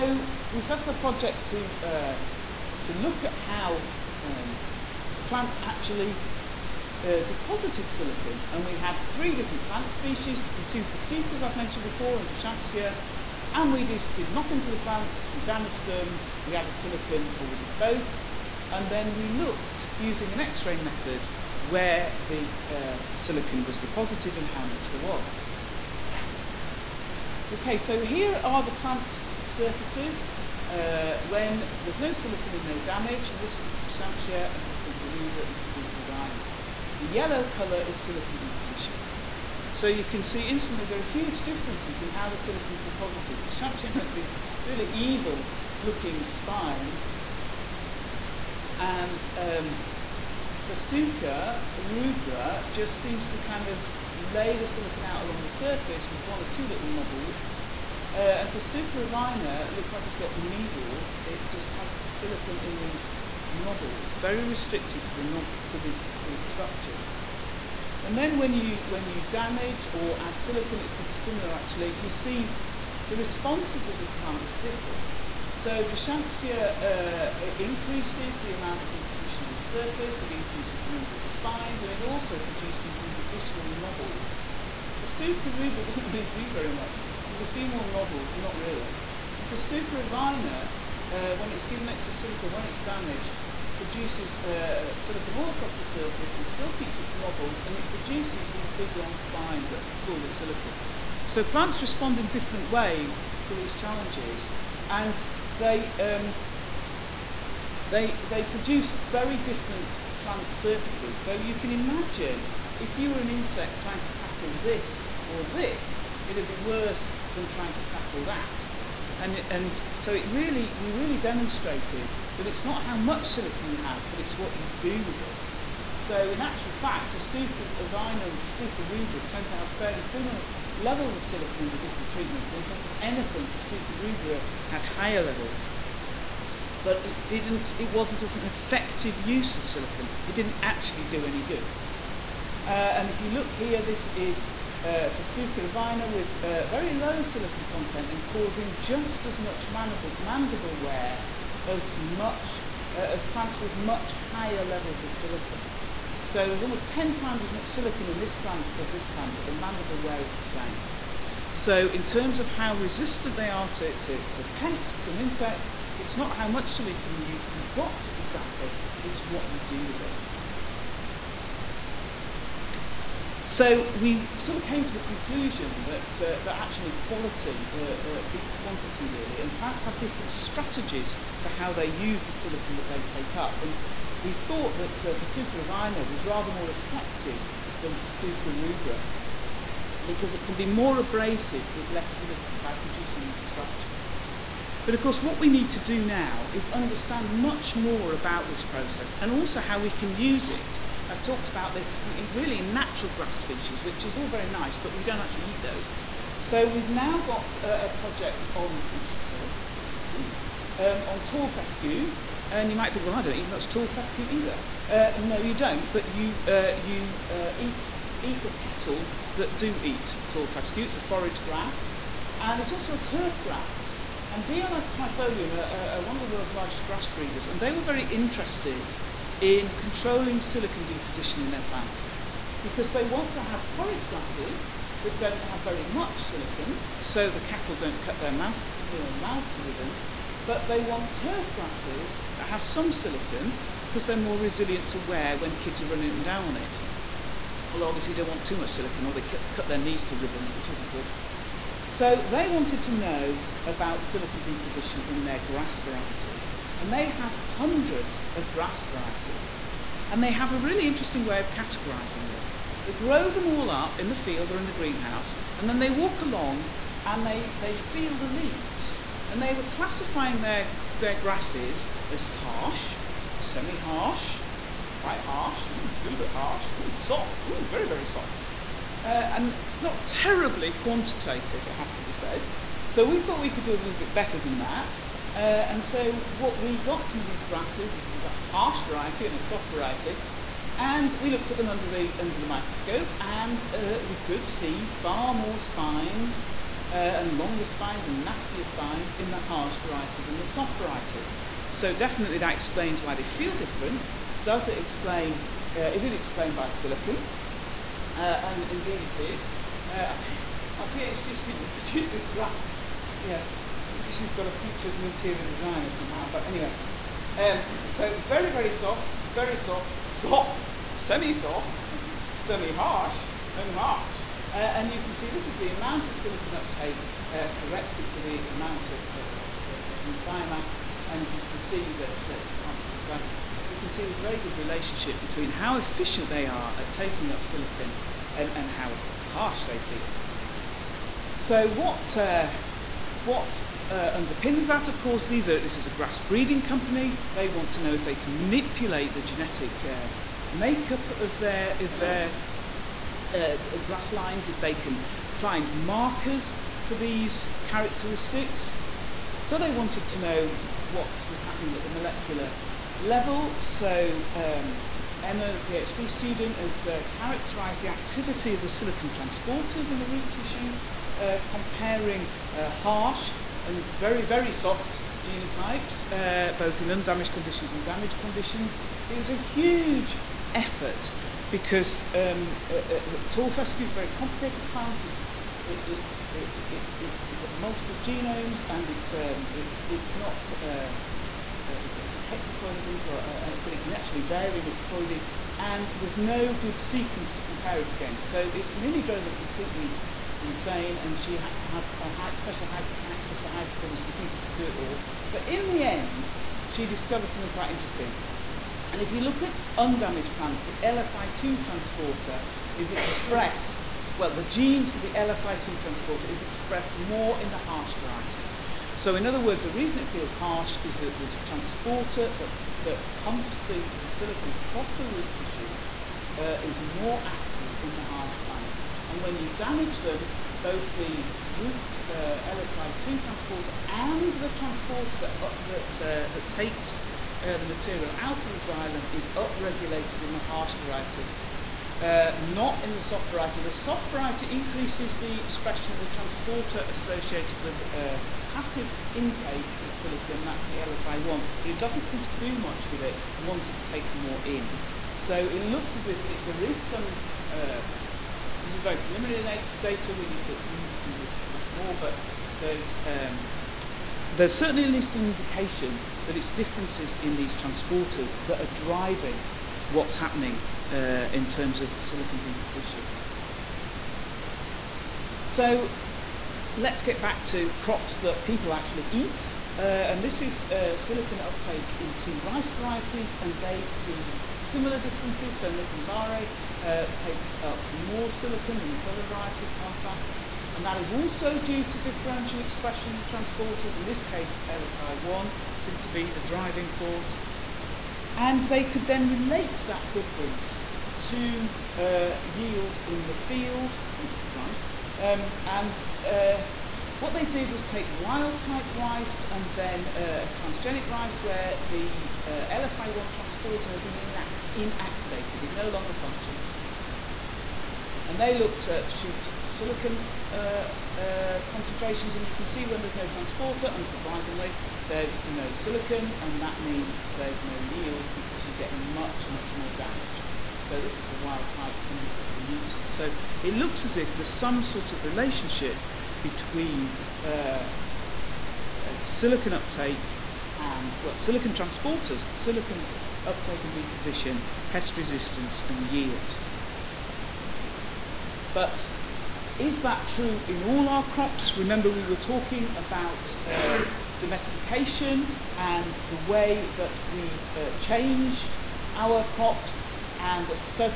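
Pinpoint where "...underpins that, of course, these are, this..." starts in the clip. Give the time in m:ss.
5:44.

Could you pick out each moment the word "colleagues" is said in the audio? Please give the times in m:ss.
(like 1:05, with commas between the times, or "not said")
not said.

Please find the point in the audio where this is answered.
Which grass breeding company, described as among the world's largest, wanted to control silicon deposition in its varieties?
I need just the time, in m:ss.
3:44.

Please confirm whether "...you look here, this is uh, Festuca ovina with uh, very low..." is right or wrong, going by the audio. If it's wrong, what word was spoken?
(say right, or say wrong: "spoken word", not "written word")
right.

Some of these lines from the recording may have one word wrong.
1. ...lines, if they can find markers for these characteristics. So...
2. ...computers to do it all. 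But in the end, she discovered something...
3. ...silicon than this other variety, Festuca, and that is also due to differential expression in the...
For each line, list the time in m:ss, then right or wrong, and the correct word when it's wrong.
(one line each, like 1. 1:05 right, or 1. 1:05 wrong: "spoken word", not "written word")
1. 5:54 right
2. 6:44 right
3. 8:08 wrong: "Kasalath", not "Festuca".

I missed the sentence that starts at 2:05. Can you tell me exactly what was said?
So in actual fact, Festuca ovina and Festuca rubra tend to have fairly similar levels of silicon in the different treatments.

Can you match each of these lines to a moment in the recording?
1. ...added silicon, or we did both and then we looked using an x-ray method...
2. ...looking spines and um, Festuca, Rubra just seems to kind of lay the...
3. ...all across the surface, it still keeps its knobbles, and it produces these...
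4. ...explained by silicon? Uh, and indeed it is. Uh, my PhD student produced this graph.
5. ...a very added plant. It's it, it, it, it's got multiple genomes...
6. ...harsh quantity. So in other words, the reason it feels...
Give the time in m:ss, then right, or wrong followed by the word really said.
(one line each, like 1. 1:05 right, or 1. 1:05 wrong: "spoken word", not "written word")
1. 0:16 right
2. 0:45 right
3. 1:35 right
4. 5:06 right
5. 6:23 wrong: "complicated", not "added"
6. 6:57 wrong: "variety", not "quantity".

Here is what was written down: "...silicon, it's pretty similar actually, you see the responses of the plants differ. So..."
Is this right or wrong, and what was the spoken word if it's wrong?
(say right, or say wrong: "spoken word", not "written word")
right.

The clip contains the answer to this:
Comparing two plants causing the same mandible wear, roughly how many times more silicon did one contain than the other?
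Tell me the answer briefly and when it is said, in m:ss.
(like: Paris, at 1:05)
10 times, at 2:36.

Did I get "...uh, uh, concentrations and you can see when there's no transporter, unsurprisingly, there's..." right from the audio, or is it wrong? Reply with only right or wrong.
right.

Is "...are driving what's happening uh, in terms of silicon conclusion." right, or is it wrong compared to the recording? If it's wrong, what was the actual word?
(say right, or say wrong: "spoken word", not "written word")
wrong: "deposition", not "conclusion".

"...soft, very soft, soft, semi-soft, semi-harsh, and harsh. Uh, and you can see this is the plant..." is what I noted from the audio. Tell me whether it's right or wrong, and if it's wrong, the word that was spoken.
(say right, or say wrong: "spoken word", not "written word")
wrong: "amount", not "plant".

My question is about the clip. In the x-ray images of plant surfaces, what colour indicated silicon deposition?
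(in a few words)
Yellow.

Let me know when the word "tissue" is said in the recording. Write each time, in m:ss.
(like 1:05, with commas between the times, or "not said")
6:10, 7:05.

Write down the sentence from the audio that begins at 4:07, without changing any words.
Well, obviously, you don't want too much silicon or they cut their knees to ribbons, which isn't good.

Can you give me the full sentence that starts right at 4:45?
Uh, and so what we got some of these grasses is there's a harsh variety and a soft variety.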